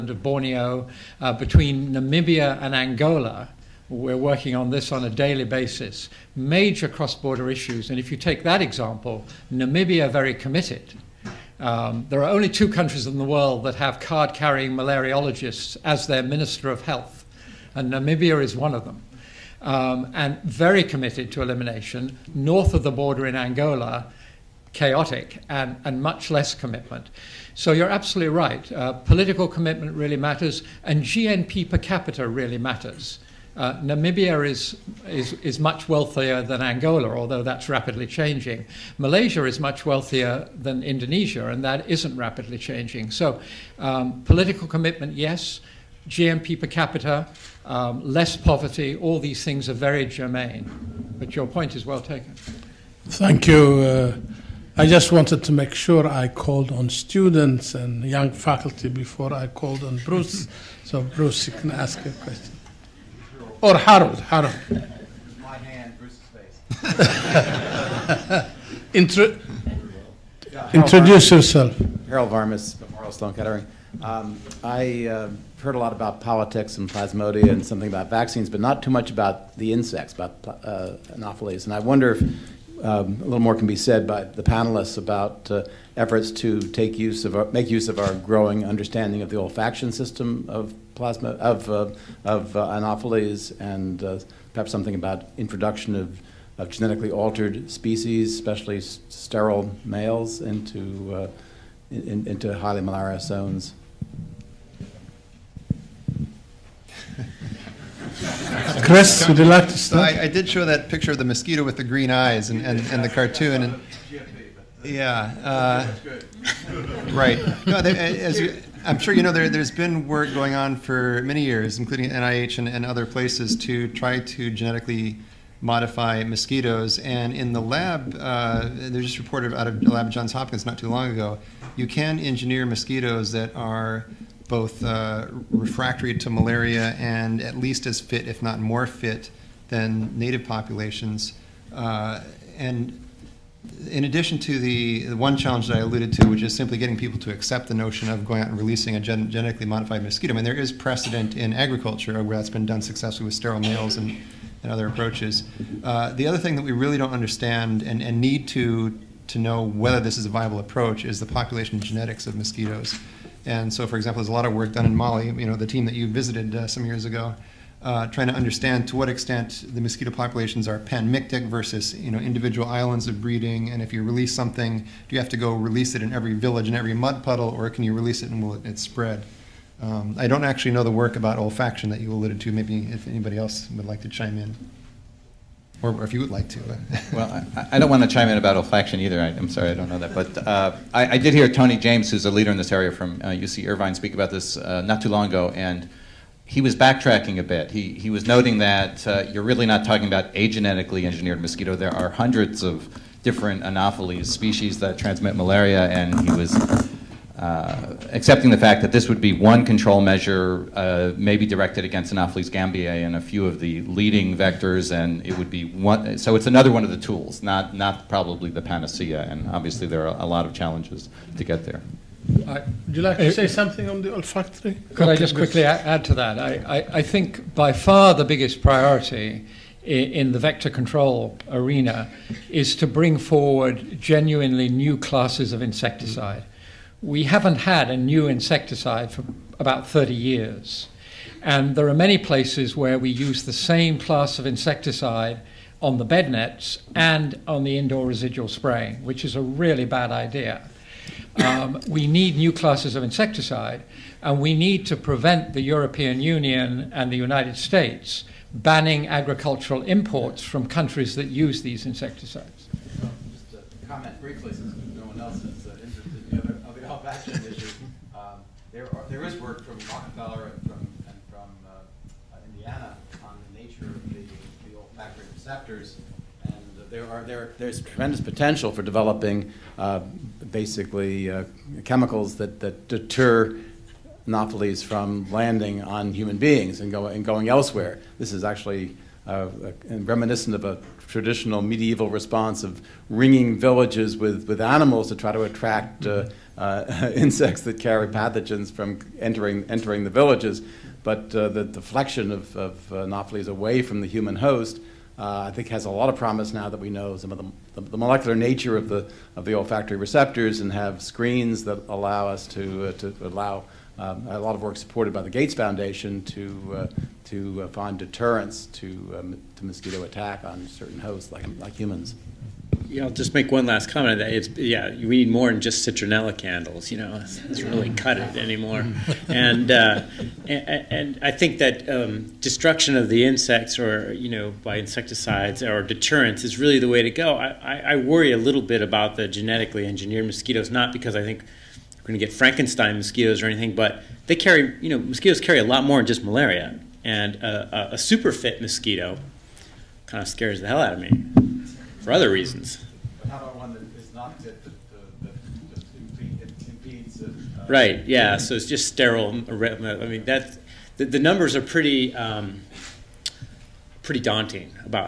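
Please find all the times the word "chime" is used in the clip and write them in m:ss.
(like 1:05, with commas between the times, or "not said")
3:04, 3:08.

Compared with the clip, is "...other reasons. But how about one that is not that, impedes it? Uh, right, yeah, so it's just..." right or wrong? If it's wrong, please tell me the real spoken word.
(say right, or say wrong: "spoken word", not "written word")
right.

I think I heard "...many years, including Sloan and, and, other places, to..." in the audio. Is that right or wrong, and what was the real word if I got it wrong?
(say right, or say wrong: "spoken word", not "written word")
wrong: "NIH", not "Sloan".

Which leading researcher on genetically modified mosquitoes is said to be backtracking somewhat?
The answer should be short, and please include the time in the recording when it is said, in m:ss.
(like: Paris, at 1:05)
Tony James, at 3:11.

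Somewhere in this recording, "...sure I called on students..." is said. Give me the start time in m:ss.
0:55.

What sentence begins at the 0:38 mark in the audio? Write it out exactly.
Malaysia is much wealthier than Indonesia, and that isn't rapidly changing.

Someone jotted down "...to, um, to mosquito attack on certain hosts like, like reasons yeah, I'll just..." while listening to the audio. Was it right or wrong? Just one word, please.
wrong.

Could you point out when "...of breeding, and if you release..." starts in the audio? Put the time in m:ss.
2:53.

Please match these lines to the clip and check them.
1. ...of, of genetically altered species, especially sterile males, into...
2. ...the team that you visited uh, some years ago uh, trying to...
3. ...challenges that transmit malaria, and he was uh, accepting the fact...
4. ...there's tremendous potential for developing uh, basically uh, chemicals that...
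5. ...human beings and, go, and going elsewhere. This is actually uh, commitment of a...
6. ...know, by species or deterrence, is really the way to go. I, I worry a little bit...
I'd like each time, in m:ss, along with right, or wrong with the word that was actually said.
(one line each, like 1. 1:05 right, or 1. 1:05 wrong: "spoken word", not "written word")
1. 1:35 right
2. 2:45 right
3. 3:24 wrong: "species", not "challenges"
4. 4:37 right
5. 4:46 wrong: "reminiscent", not "commitment"
6. 5:34 wrong: "insecticides", not "species".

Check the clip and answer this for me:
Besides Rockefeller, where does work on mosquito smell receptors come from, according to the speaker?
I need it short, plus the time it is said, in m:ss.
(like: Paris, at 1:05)
Indiana, at 4:32.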